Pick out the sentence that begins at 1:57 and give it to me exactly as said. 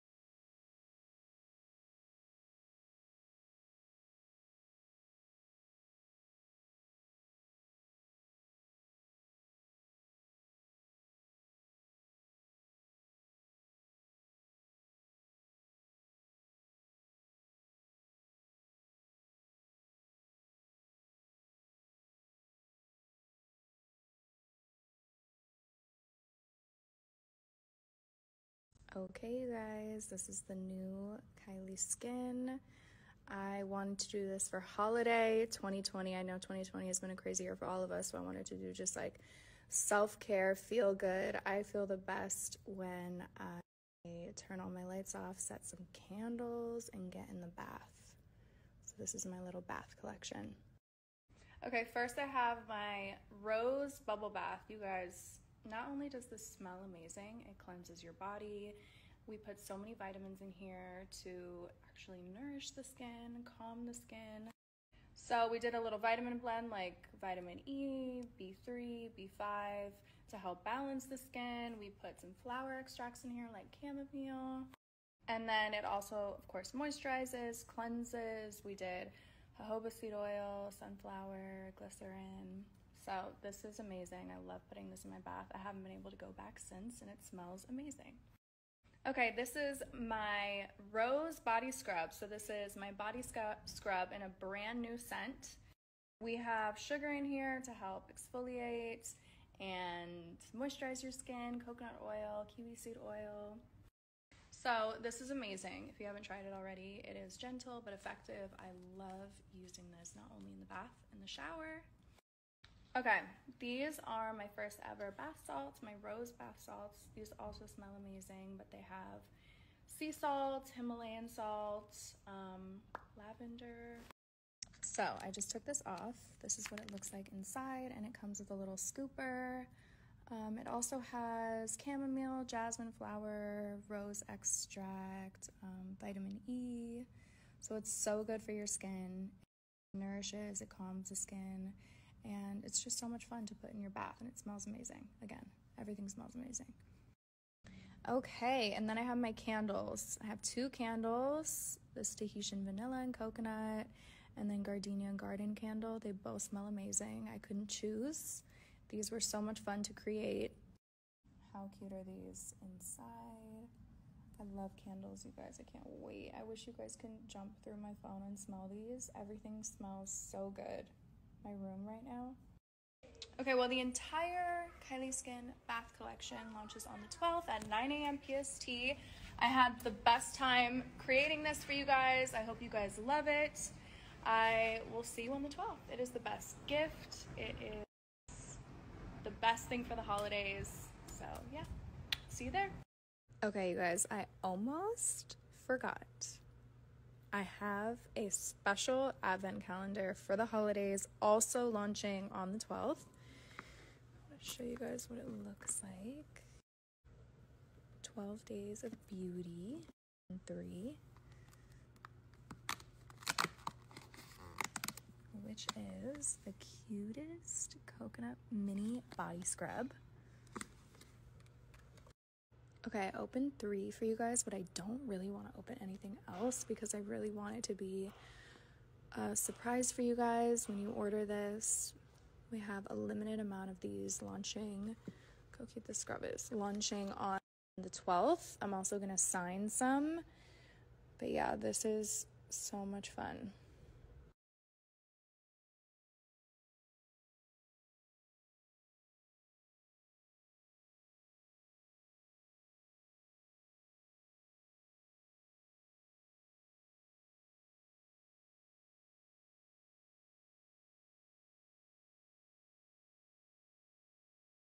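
These also smell amazing, but they have sea salt, Himalayan salt, um, lavender.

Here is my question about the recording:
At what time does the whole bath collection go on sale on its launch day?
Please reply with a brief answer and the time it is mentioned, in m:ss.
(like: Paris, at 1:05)
9 a.m. PST, at 2:57.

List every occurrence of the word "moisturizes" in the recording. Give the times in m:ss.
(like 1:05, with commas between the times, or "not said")
1:16, 1:40.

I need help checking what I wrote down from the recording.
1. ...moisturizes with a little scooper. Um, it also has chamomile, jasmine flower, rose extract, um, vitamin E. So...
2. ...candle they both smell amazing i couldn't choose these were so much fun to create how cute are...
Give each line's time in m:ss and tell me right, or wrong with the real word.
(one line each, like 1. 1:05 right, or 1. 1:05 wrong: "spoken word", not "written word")
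1. 2:08 wrong: "comes", not "moisturizes"
2. 2:35 right.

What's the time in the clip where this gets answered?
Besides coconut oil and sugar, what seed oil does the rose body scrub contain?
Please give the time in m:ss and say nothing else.
1:42.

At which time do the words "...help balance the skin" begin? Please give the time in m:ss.
1:10.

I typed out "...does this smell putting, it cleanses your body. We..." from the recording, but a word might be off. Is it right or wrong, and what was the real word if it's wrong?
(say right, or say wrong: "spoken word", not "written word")
wrong: "amazing", not "putting".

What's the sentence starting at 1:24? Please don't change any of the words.
I love putting this in my bath.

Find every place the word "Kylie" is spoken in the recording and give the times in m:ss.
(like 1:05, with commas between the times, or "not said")
0:31, 2:54.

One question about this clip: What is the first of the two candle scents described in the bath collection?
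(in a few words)
Tahitian vanilla and coconut.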